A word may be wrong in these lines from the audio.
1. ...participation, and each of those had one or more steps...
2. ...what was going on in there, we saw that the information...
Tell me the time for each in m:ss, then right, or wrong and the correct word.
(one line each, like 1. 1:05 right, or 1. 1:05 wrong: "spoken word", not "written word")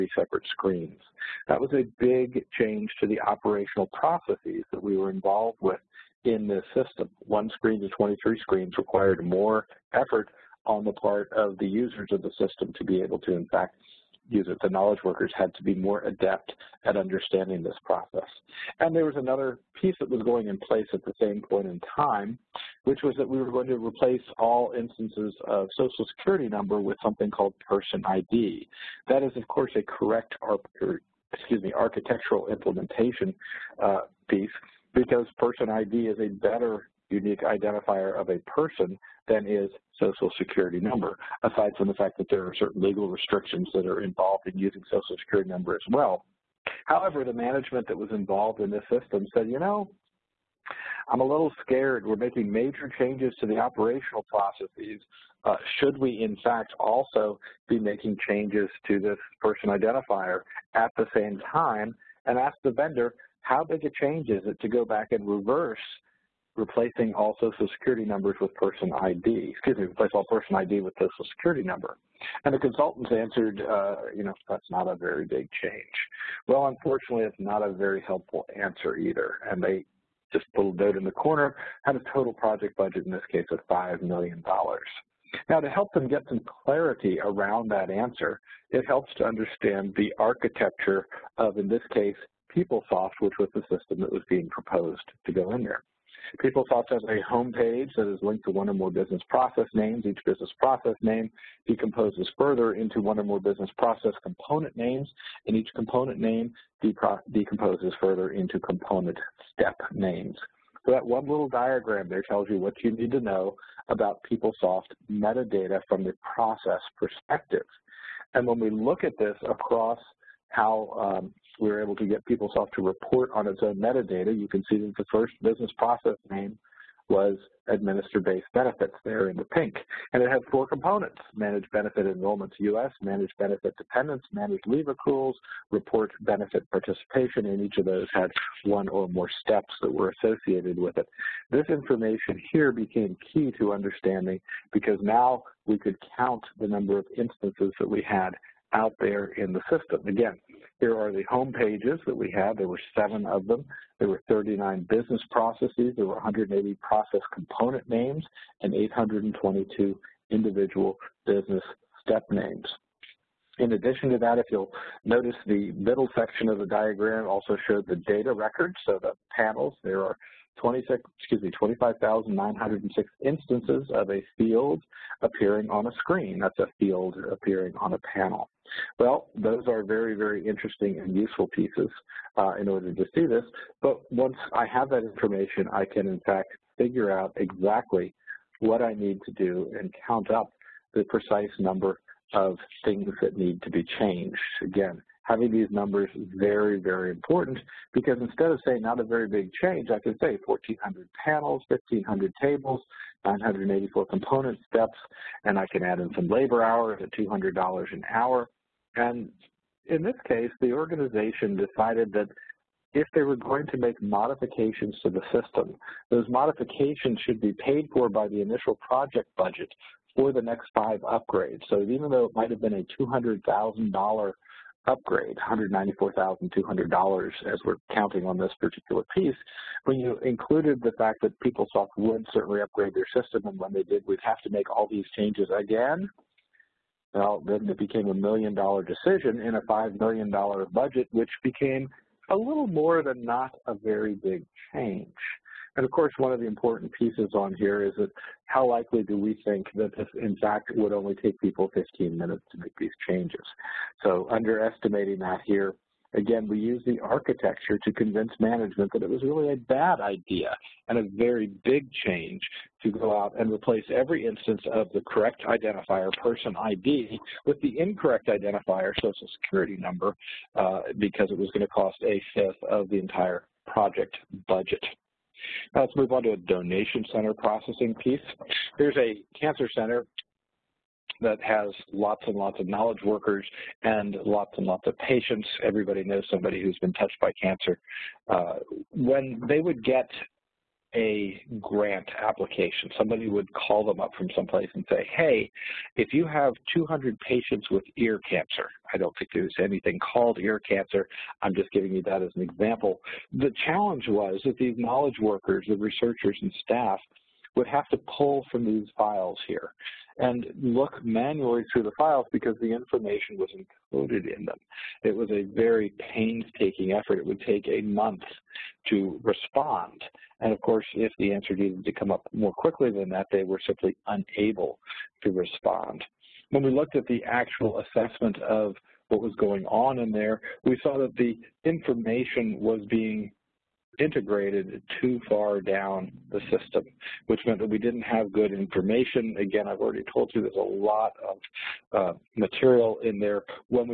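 1. 2:16 right
2. 5:29 right.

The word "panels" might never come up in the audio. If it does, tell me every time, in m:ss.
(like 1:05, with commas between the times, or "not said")
2:49, 2:57, 3:21.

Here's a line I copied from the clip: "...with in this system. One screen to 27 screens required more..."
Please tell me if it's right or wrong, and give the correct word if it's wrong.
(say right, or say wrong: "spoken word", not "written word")
wrong: "23", not "27".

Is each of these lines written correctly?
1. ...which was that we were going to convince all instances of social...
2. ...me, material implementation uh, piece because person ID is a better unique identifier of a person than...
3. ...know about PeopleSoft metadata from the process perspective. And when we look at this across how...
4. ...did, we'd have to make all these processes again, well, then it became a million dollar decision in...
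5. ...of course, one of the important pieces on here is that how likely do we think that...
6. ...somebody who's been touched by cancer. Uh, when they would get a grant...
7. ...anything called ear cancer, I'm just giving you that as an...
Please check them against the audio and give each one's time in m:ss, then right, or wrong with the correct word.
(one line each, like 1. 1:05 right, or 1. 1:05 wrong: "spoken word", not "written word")
1. 0:22 wrong: "replace", not "convince"
2. 0:31 wrong: "architectural", not "material"
3. 1:53 right
4. 3:53 wrong: "changes", not "processes"
5. 4:05 right
6. 4:46 right
7. 4:59 right.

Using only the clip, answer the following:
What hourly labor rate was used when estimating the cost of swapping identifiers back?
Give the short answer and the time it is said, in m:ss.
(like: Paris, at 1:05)
$200 an hour, at 3:27.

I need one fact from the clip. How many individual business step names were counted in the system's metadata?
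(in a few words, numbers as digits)
822.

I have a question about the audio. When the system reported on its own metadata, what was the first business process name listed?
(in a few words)
administer based benefits.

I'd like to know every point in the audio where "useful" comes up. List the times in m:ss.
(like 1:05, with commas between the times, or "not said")
3:01.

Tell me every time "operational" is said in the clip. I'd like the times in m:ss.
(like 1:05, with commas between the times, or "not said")
0:03, 0:53.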